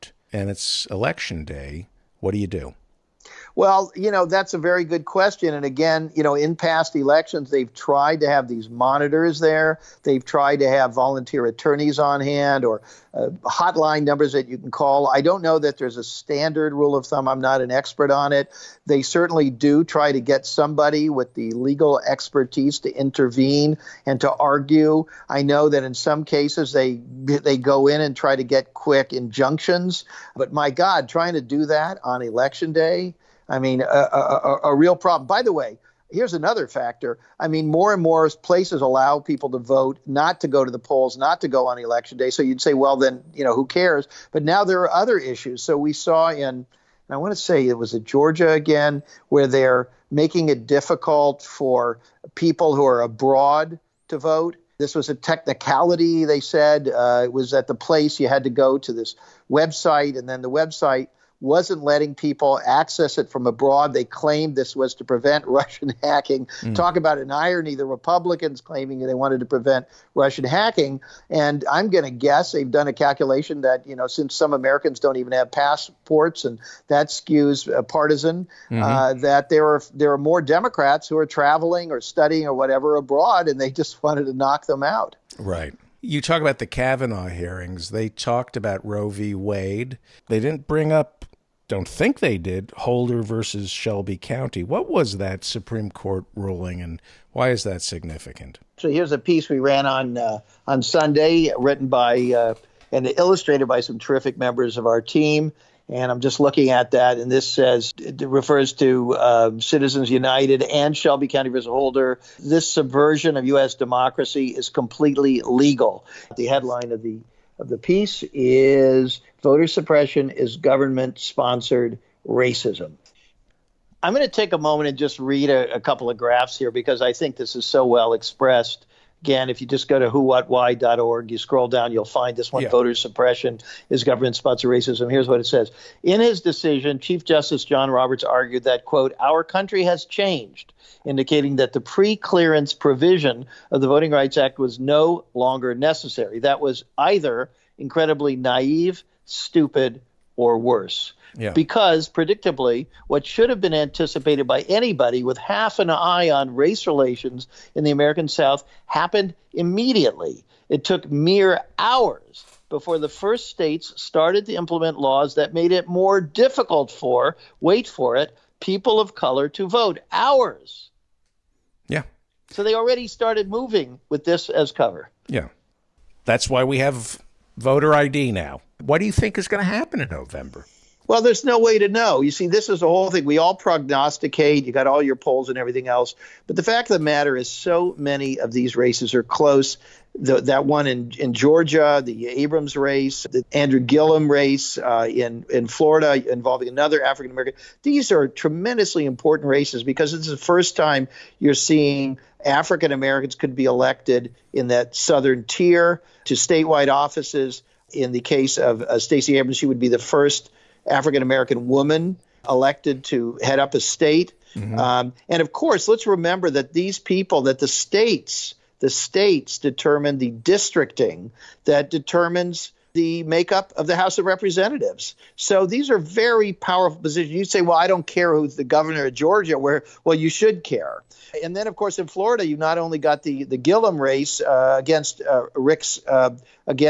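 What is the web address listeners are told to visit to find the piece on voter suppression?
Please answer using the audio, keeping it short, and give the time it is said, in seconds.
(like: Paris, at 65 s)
whowhatwhy.org, at 130 s.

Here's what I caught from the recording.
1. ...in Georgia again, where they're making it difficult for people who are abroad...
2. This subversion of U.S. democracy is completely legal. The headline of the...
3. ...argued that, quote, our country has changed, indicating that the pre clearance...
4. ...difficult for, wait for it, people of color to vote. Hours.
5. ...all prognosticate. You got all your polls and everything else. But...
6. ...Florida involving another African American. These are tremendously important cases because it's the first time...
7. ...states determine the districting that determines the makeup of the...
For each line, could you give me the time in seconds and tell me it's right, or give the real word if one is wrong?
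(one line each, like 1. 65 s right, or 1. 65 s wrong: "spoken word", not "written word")
1. 47 s right
2. 112 s right
3. 138 s right
4. 166 s right
5. 183 s right
6. 195 s wrong: "races", not "cases"
7. 218 s right.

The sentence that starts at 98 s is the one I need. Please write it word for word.
So here's a piece we ran on uh, on Sunday, written by uh, and illustrated by some terrific members of our team.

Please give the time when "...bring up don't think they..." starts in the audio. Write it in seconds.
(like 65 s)
90 s.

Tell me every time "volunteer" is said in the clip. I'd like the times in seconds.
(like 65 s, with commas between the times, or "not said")
10 s.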